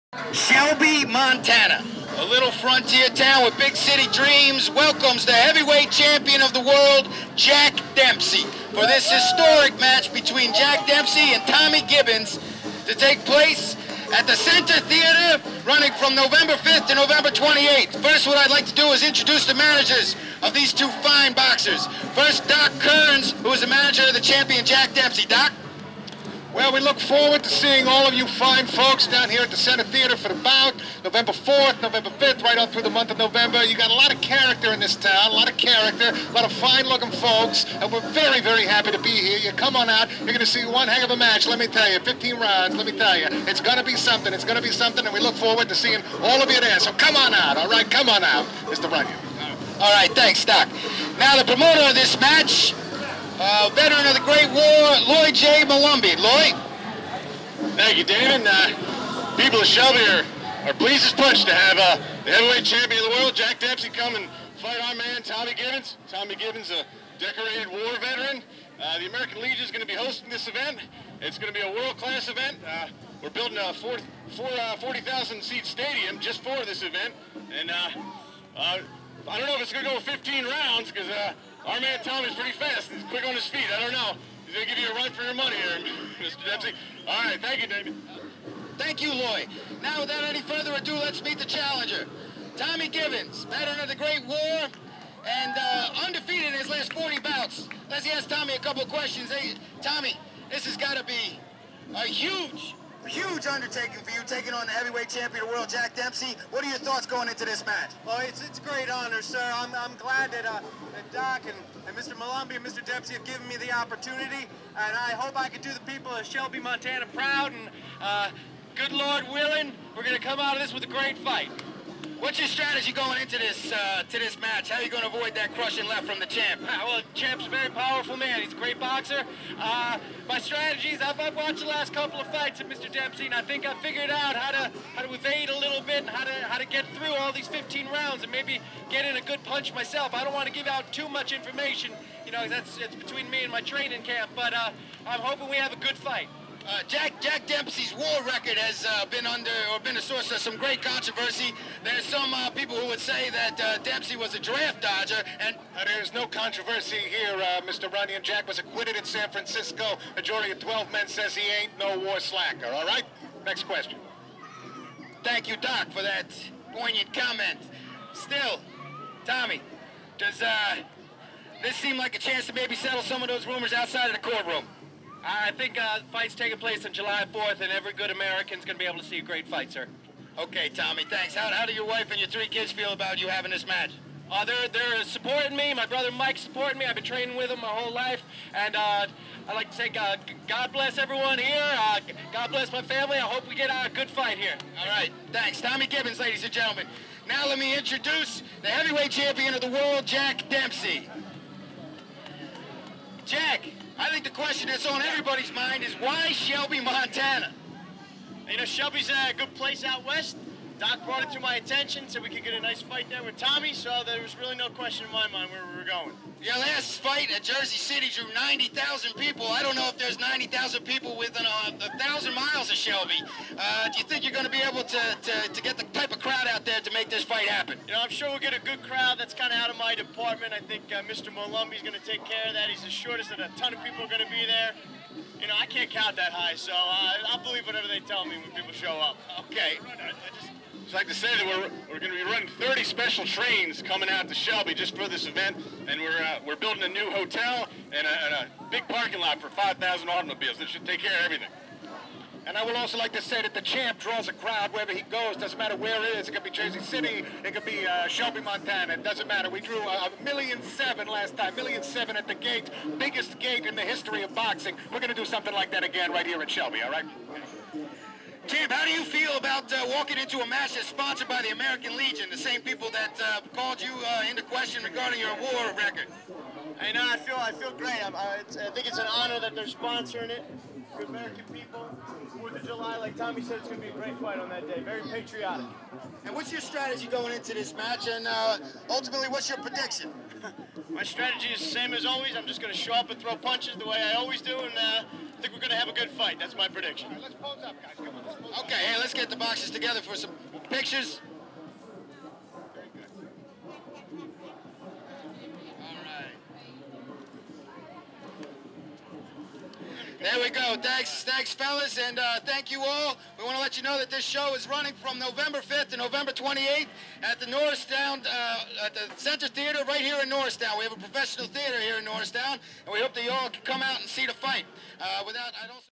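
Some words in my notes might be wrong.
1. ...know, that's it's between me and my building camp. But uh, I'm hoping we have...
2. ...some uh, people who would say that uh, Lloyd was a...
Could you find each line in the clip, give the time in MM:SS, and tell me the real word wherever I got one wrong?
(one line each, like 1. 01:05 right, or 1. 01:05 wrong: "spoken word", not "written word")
1. 02:22 wrong: "training", not "building"
2. 02:32 wrong: "Dempsey", not "Lloyd".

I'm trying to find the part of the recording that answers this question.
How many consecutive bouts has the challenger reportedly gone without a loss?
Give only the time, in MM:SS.
01:36.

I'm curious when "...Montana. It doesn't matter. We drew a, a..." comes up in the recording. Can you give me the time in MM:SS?
04:18.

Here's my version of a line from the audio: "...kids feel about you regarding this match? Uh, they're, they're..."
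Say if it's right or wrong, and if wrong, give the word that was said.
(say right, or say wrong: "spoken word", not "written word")
wrong: "having", not "regarding".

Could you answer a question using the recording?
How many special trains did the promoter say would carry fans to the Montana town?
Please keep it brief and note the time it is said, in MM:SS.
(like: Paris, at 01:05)
30, at 04:02.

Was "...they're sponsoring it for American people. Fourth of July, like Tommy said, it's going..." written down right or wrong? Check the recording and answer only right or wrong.
right.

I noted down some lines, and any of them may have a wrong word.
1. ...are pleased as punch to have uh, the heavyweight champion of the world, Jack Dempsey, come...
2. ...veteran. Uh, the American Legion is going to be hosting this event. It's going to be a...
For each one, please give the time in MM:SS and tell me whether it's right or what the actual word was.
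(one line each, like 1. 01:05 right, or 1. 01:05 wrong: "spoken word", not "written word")
1. 01:00 right
2. 01:07 right.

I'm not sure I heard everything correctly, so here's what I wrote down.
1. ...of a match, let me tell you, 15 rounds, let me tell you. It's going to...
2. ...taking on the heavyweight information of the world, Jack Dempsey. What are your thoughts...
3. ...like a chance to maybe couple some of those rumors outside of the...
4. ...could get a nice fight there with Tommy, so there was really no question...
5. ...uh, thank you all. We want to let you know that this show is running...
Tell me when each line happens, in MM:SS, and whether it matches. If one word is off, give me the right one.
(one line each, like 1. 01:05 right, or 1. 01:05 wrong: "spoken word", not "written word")
1. 00:41 right
2. 01:44 wrong: "champion", not "information"
3. 02:51 wrong: "settle", not "couple"
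4. 03:32 right
5. 05:12 right.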